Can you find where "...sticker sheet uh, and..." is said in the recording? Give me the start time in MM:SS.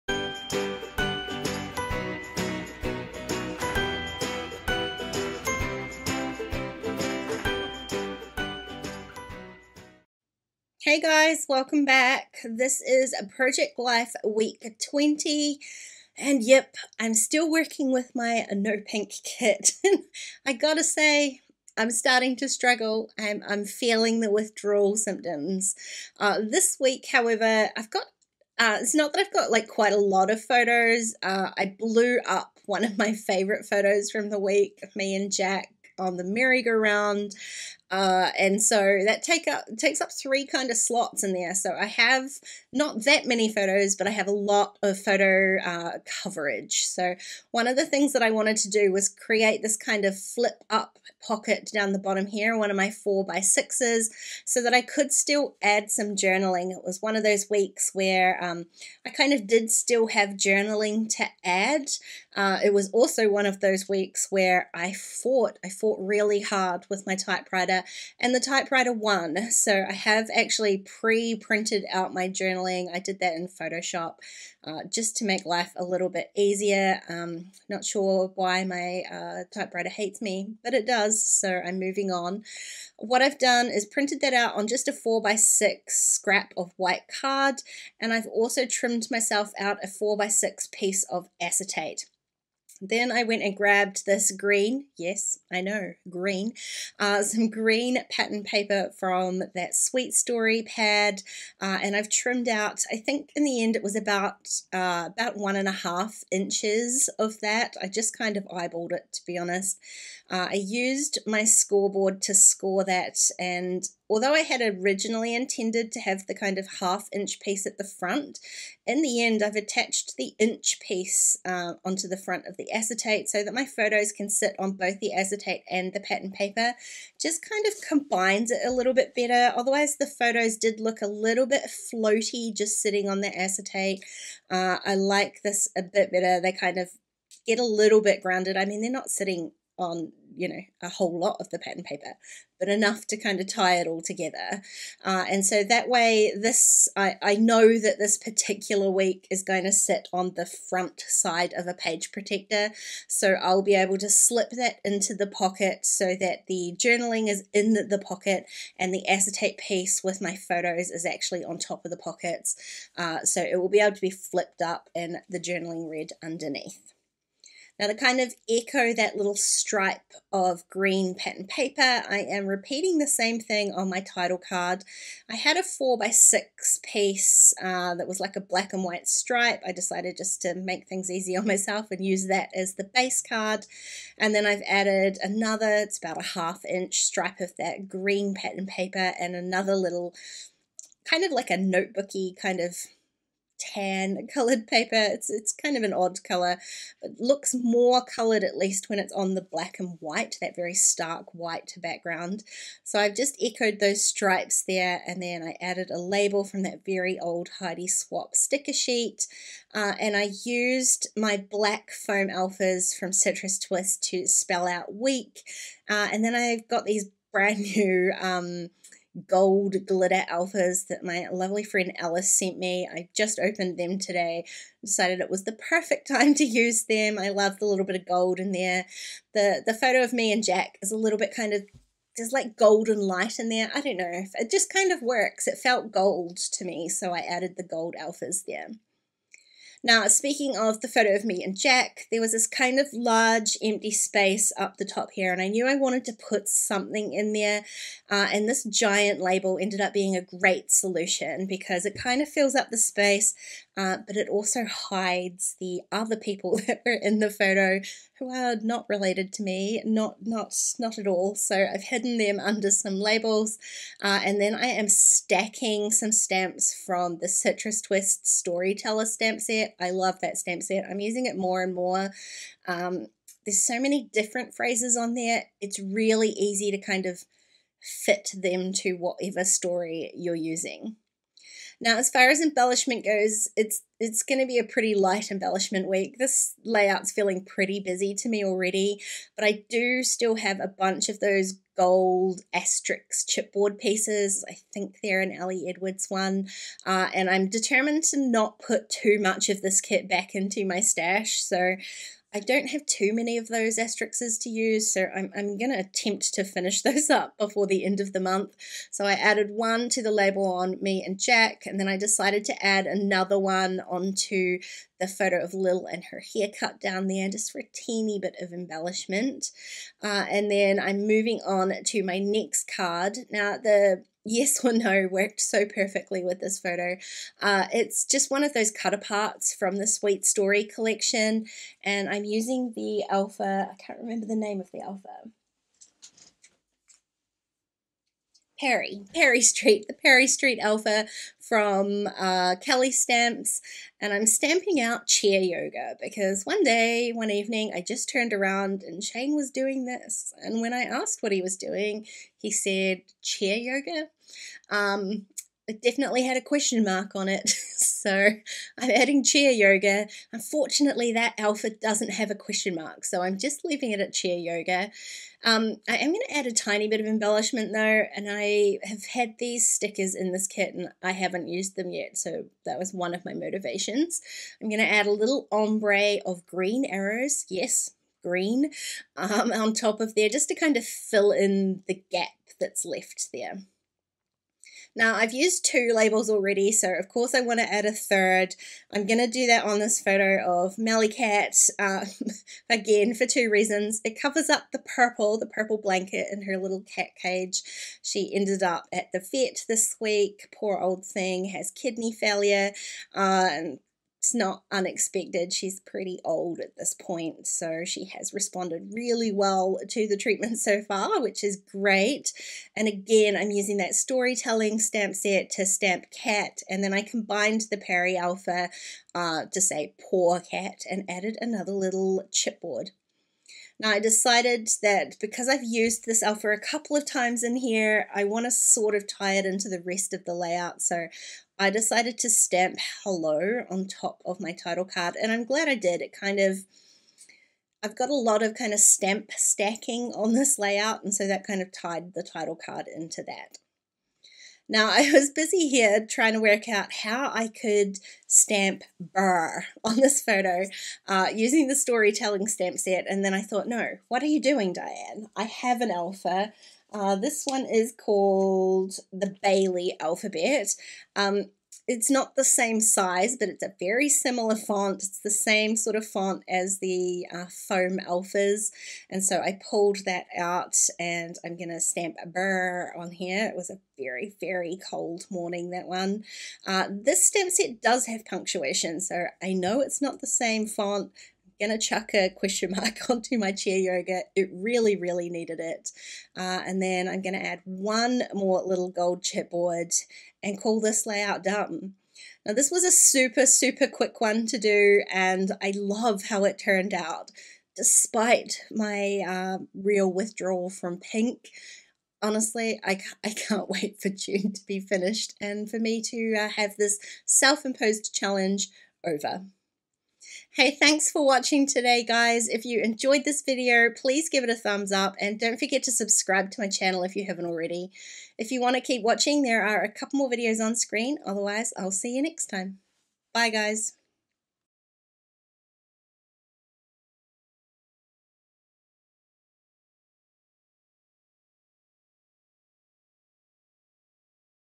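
03:28.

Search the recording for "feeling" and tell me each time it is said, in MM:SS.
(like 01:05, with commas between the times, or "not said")
00:23, 04:47.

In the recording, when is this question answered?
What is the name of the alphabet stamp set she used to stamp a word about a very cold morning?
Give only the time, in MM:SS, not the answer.
07:39.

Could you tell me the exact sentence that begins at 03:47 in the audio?
I love the little bit of gold in there.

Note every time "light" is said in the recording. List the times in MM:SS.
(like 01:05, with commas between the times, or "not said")
03:52, 04:44.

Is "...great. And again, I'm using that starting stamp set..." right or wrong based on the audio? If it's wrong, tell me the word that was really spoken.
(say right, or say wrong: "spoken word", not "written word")
wrong: "storytelling", not "starting".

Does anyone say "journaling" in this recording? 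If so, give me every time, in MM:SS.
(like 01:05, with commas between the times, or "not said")
00:56, 01:00, 01:12, 02:36, 02:45.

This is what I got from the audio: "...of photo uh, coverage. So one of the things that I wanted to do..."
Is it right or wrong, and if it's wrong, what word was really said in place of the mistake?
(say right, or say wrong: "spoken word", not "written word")
right.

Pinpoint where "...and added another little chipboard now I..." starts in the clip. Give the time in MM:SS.
07:00.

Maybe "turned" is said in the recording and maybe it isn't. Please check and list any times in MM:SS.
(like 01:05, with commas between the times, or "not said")
05:48, 08:16.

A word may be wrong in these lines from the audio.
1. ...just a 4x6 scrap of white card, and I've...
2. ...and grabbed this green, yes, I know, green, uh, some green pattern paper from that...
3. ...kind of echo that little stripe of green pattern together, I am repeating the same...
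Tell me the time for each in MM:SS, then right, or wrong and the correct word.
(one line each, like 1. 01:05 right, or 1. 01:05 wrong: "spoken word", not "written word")
1. 01:24 right
2. 01:33 right
3. 02:47 wrong: "paper", not "together".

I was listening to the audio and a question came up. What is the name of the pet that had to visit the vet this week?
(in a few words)
Melly Cat.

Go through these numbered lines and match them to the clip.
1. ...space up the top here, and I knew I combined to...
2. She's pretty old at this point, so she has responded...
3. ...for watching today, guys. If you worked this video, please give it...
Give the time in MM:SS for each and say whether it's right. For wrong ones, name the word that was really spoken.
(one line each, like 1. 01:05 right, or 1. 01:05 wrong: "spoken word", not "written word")
1. 04:03 wrong: "wanted", not "combined"
2. 06:45 right
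3. 08:31 wrong: "enjoyed", not "worked".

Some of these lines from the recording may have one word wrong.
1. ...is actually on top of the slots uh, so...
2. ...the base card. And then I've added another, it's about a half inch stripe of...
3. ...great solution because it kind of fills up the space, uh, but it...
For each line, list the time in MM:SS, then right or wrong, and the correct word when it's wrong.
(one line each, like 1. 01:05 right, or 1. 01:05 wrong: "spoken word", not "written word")
1. 02:40 wrong: "pockets", not "slots"
2. 03:02 right
3. 04:10 right.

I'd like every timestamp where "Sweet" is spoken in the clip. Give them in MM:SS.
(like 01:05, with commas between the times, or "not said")
01:39, 05:29.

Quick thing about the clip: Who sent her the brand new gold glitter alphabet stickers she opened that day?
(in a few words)
Alice.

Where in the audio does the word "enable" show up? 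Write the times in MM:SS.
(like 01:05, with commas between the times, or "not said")
not said.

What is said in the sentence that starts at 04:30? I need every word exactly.
I'm using it more and more.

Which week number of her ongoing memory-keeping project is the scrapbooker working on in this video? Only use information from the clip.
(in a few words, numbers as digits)
20.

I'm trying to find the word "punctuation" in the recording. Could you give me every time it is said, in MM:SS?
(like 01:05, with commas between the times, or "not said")
07:58.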